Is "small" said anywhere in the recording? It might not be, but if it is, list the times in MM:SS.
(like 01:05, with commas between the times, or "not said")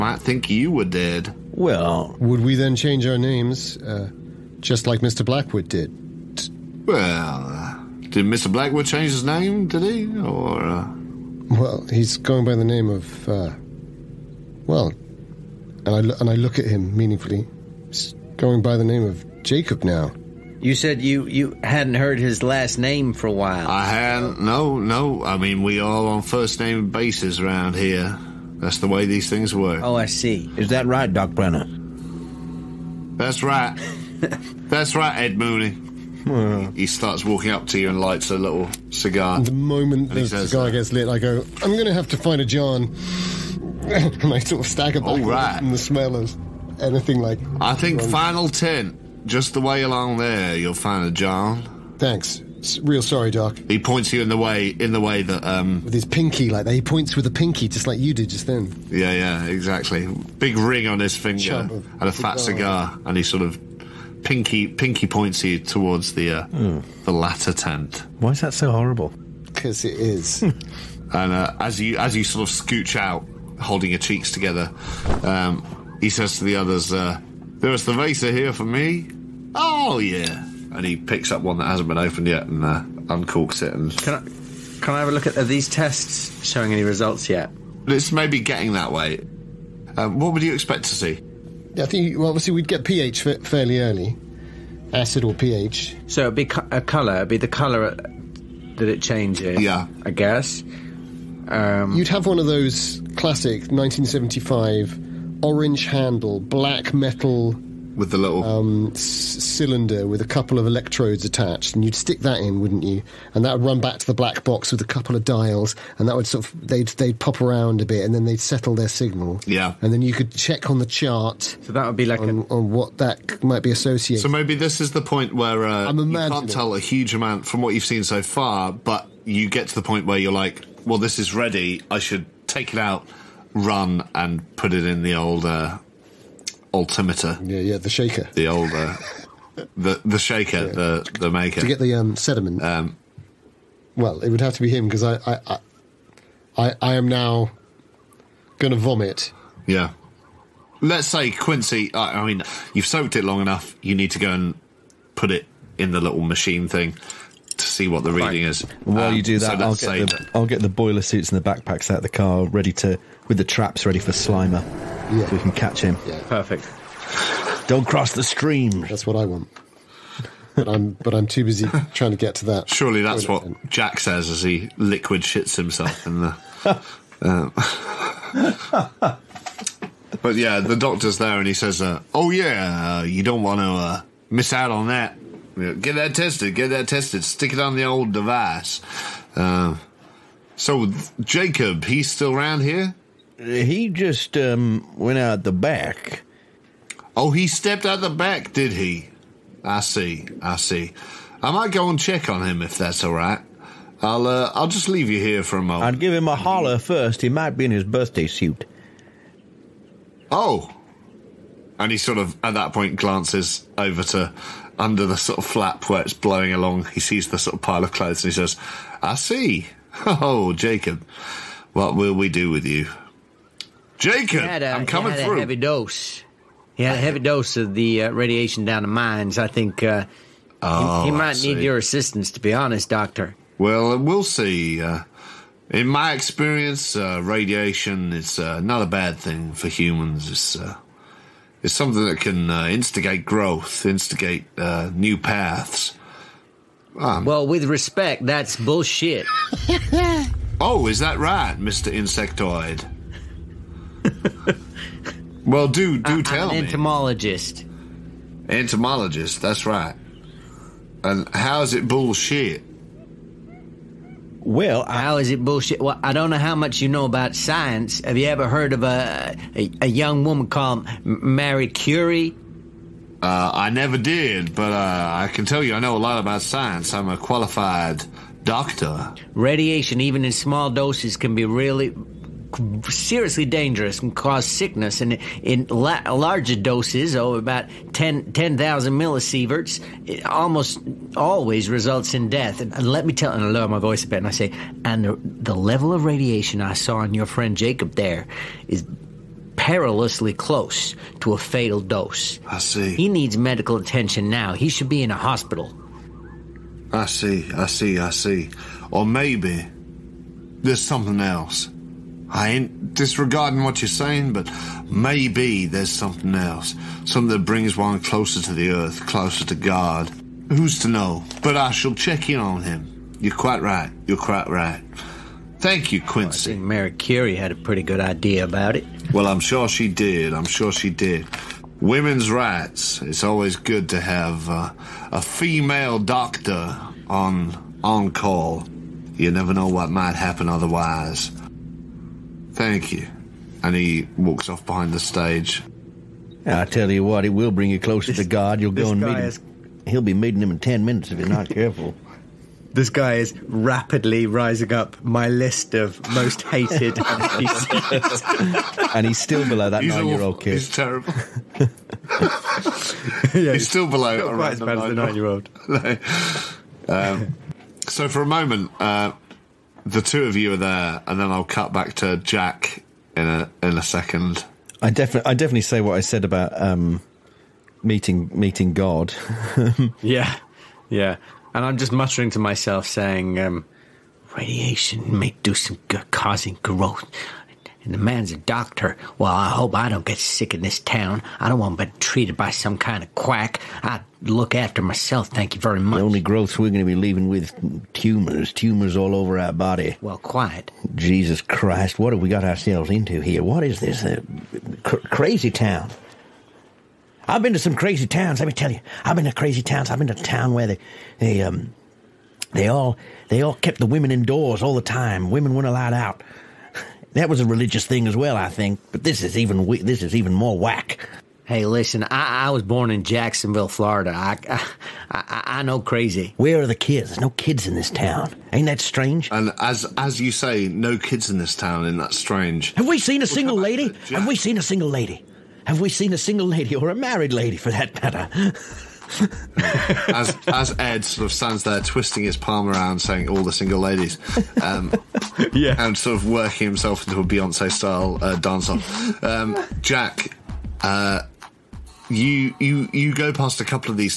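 04:40.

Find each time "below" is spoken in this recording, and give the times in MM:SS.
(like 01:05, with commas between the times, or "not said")
05:59, 06:03.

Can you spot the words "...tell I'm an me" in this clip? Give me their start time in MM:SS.
04:16.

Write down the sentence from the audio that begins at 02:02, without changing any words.
on what that might be associated.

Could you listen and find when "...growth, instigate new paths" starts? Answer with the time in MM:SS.
04:03.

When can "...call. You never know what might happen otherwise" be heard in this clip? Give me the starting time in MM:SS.
05:38.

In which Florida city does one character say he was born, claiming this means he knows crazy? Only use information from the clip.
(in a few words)
Jacksonville.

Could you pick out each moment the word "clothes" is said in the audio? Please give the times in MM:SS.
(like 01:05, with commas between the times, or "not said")
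03:37.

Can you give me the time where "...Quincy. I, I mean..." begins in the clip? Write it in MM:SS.
02:31.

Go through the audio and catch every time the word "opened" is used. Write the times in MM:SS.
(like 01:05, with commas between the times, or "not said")
01:21.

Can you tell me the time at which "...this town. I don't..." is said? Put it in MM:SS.
06:30.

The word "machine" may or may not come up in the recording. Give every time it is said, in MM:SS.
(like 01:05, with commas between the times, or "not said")
02:36.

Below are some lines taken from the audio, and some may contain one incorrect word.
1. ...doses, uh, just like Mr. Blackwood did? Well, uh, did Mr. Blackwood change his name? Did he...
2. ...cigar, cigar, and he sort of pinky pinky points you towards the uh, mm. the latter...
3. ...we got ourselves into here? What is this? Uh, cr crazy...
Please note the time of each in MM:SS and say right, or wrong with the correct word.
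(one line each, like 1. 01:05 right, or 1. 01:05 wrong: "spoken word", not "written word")
1. 00:03 wrong: "names", not "doses"
2. 01:02 right
3. 06:42 right.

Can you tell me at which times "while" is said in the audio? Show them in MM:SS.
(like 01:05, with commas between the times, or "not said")
00:23, 02:38.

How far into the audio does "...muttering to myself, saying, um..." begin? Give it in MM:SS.
06:21.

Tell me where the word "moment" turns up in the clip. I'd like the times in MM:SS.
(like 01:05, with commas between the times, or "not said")
00:39, 03:25, 06:08.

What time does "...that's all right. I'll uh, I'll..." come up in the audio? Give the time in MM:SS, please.
03:22.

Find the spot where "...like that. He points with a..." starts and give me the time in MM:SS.
00:56.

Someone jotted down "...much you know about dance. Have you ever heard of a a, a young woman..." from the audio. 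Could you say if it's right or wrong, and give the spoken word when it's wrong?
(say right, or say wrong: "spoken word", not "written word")
wrong: "science", not "dance".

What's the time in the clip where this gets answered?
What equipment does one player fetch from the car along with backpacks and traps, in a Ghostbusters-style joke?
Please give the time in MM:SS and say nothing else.
02:40.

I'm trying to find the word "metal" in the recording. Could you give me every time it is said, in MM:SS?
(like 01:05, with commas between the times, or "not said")
01:46.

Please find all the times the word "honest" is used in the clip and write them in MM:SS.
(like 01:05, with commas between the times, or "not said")
03:52.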